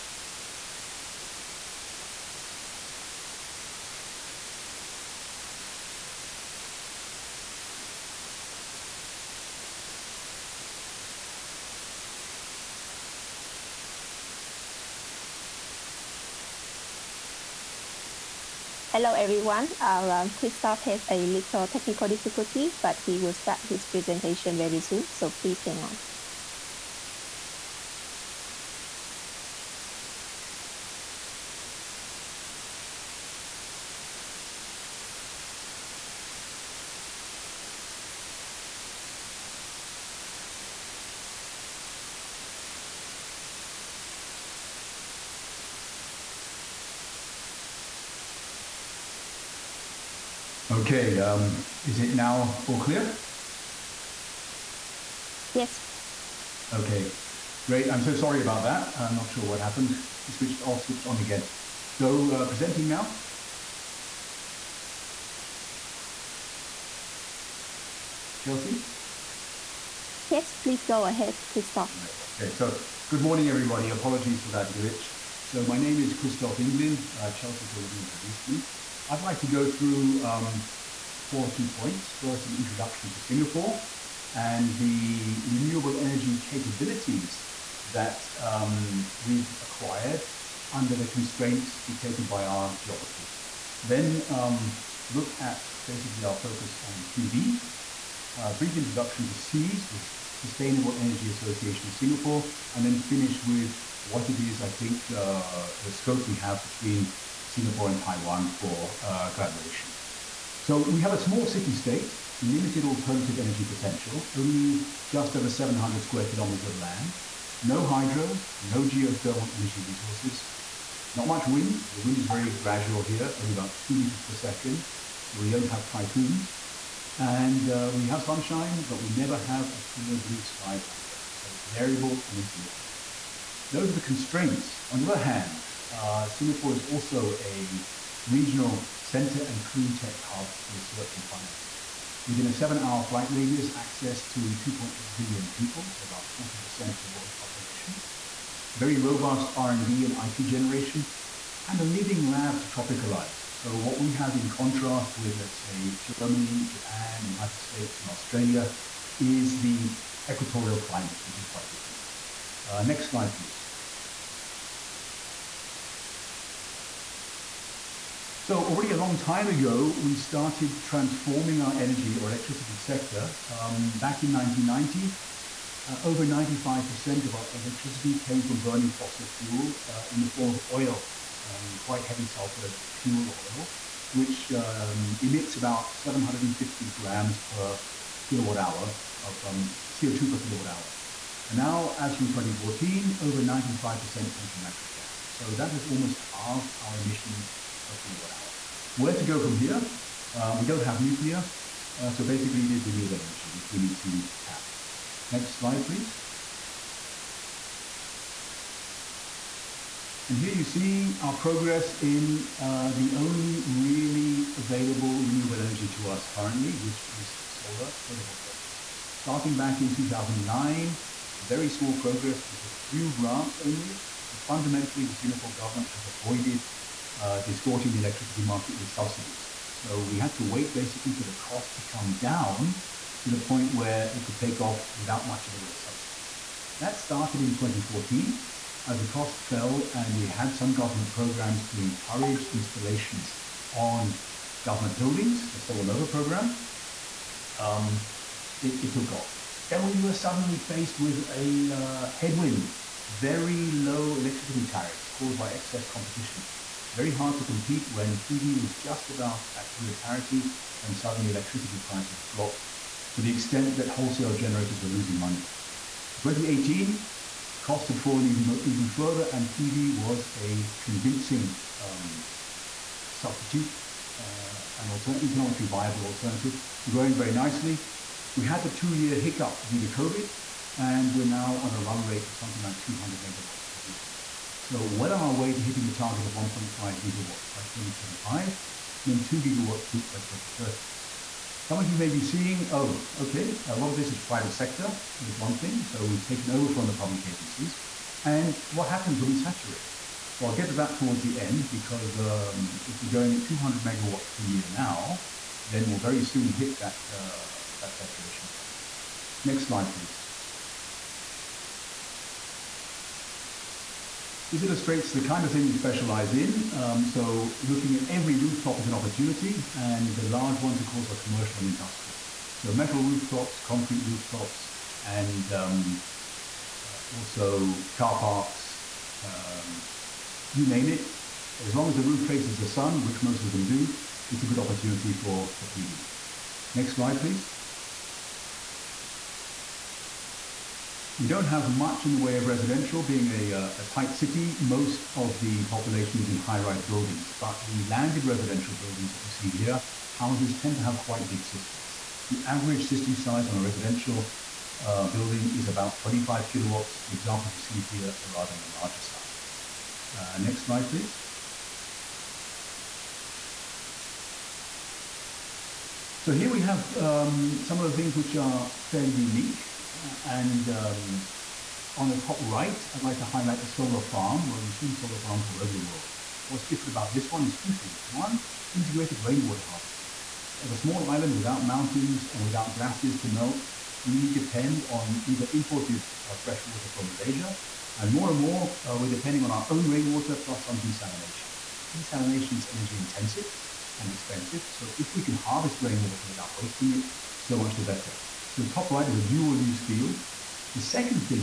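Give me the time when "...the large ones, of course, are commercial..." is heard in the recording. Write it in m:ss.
5:20.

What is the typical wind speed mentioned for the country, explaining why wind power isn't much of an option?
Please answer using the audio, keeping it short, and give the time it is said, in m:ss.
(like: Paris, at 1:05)
2 meters per second, at 2:03.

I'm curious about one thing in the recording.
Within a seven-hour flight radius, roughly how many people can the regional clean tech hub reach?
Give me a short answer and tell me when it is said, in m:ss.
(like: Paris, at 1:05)
2.8 billion, at 2:24.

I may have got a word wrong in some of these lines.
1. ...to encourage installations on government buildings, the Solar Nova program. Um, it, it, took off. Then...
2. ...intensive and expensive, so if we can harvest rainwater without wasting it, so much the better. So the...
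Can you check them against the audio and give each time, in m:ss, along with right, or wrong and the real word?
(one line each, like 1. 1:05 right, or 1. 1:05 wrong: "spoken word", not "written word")
1. 4:01 right
2. 6:32 right.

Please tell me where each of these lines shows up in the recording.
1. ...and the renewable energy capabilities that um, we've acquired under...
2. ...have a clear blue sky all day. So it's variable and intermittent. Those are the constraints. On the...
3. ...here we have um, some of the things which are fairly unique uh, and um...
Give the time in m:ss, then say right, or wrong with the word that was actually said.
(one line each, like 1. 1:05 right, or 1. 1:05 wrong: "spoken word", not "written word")
1. 1:24 right
2. 2:09 right
3. 6:06 right.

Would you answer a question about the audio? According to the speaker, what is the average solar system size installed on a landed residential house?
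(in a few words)
25 kilowatts.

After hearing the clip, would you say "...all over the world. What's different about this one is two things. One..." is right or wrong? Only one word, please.
right.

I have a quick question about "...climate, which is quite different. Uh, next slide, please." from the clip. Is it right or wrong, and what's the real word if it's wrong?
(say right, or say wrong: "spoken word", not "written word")
right.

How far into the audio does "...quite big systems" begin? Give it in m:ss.
5:50.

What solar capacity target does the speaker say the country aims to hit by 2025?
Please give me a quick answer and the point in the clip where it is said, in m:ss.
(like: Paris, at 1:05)
1.5 gigawatts, at 4:46.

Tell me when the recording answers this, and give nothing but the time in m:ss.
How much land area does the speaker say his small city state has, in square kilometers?
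1:55.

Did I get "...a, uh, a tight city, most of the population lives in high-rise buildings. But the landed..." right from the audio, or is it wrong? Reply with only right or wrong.
right.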